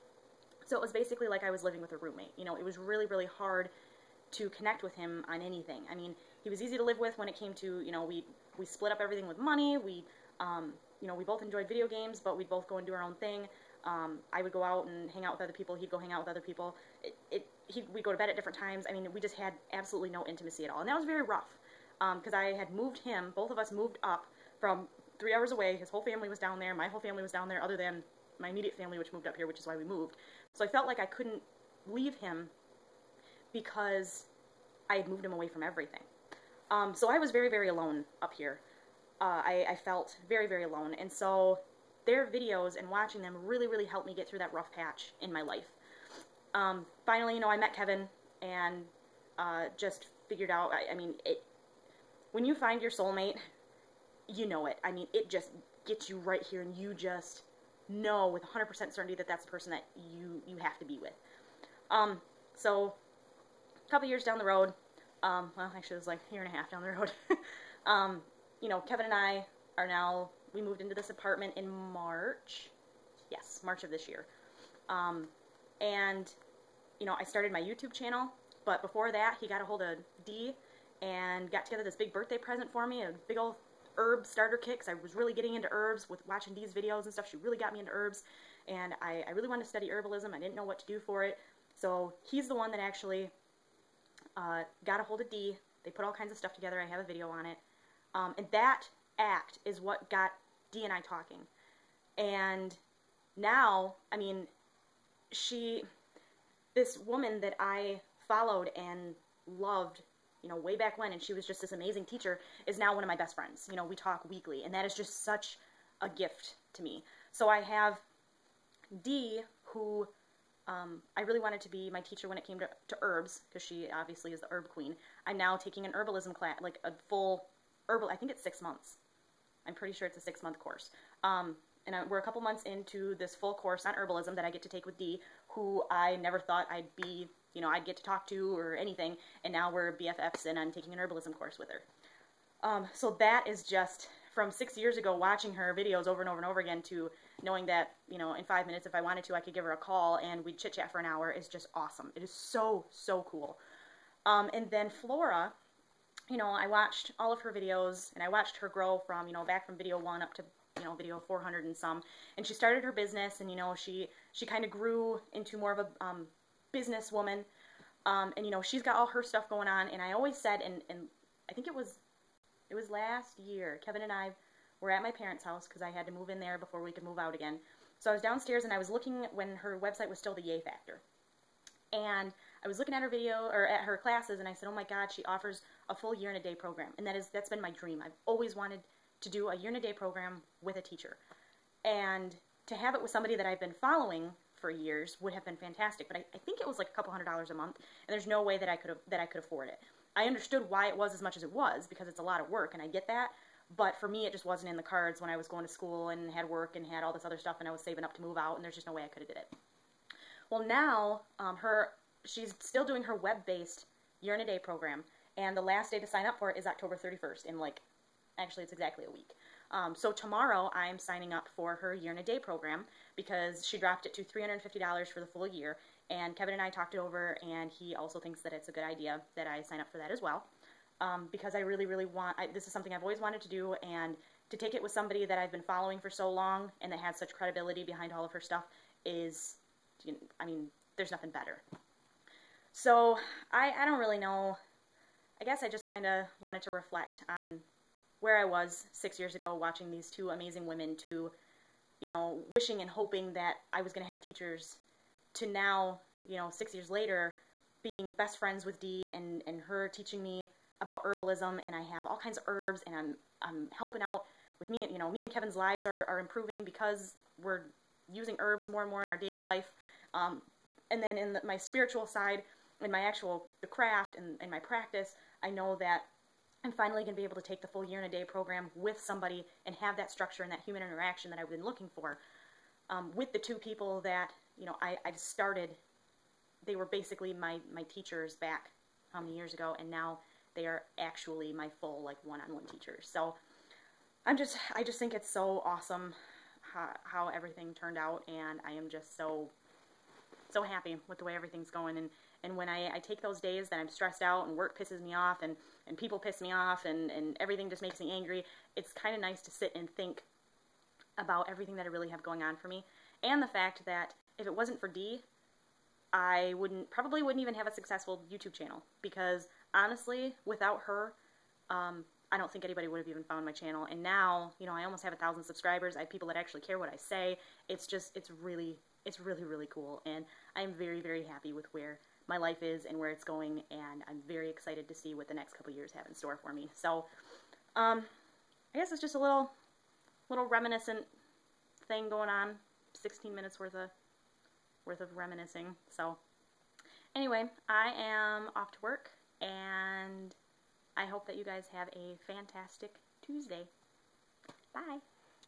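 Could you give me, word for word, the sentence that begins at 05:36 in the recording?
So, um, I guess it's just a little, little reminiscent thing going on.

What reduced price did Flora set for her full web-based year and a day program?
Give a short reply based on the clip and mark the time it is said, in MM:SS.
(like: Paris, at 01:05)
$350, at 03:44.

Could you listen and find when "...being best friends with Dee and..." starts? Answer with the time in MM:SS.
04:17.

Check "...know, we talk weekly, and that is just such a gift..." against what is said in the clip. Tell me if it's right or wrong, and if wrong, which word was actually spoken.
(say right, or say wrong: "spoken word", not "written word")
right.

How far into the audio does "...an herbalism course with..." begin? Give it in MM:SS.
02:20.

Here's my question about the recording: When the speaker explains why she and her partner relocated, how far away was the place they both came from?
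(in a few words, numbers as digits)
3 hours away.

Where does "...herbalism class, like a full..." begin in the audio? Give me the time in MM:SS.
02:05.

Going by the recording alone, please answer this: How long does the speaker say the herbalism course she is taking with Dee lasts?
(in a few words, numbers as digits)
6 months.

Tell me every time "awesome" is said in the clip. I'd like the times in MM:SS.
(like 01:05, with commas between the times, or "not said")
02:31, 04:55.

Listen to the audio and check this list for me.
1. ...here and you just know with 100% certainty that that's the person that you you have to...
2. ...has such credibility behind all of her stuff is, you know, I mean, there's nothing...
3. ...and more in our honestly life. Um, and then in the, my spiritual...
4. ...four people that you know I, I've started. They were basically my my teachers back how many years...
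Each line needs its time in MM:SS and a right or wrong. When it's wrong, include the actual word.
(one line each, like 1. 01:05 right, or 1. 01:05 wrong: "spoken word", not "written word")
1. 00:56 right
2. 03:56 right
3. 04:28 wrong: "daily", not "honestly"
4. 04:43 wrong: "two", not "four".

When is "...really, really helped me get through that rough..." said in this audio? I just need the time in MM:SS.
00:43.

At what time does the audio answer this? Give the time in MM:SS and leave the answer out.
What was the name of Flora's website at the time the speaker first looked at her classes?
03:00.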